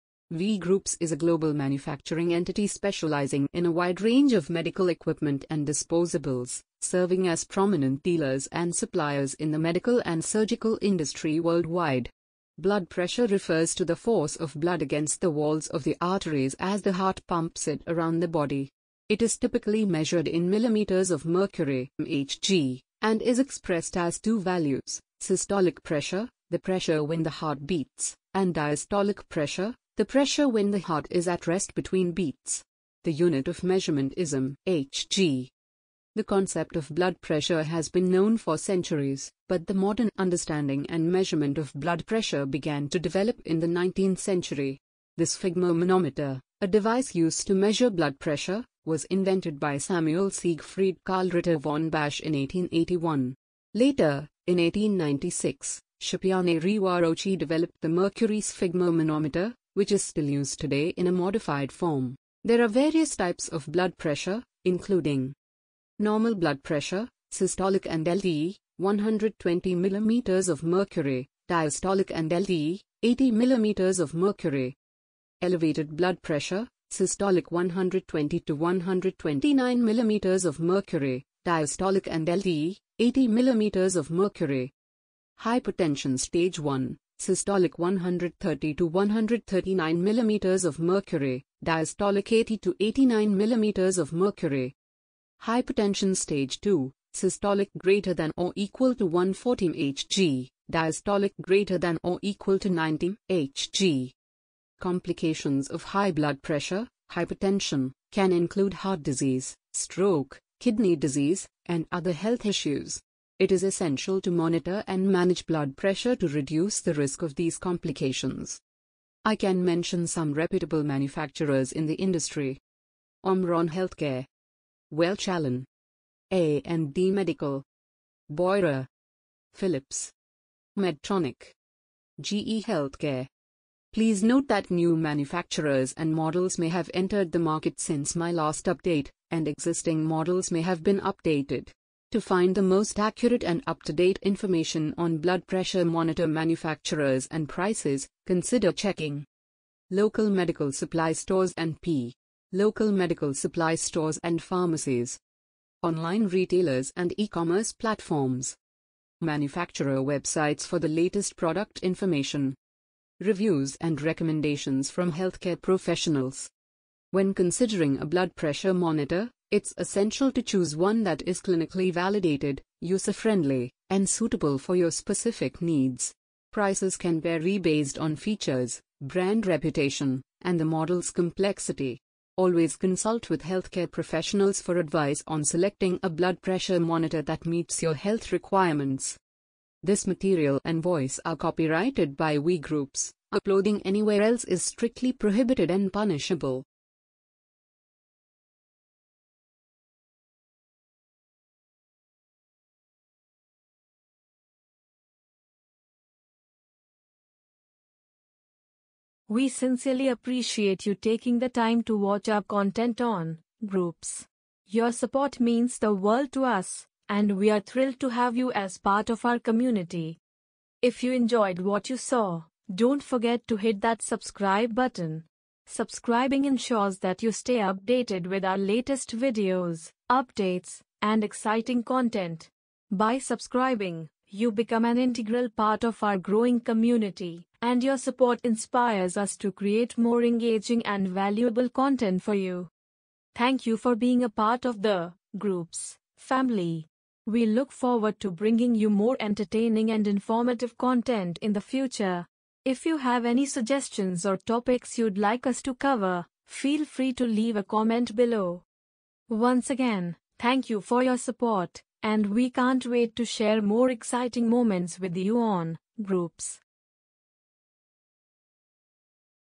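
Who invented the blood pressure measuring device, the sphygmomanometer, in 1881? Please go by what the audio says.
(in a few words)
Samuel Siegfried Karl Ritter von Basch.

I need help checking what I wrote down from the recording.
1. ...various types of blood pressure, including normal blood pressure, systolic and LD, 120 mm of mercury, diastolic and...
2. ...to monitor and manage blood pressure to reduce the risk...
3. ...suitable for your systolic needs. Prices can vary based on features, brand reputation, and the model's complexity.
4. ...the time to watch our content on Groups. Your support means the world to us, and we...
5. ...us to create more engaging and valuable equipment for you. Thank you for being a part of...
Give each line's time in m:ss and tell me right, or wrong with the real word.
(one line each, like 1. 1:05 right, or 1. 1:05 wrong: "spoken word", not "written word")
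1. 1:02 right
2. 1:54 right
3. 2:54 wrong: "specific", not "systolic"
4. 3:31 right
5. 3:59 wrong: "content", not "equipment".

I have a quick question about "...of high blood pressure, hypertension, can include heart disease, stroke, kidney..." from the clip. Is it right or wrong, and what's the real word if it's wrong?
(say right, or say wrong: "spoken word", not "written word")
right.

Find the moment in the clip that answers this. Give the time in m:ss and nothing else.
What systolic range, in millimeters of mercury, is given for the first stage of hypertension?
1:27.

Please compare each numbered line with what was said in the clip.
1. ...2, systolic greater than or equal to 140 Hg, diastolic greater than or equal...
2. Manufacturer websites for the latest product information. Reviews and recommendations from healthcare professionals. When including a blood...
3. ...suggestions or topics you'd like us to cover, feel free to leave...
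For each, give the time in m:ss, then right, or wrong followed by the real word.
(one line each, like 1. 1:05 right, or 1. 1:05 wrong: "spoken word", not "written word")
1. 1:36 right
2. 2:39 wrong: "considering", not "including"
3. 4:13 right.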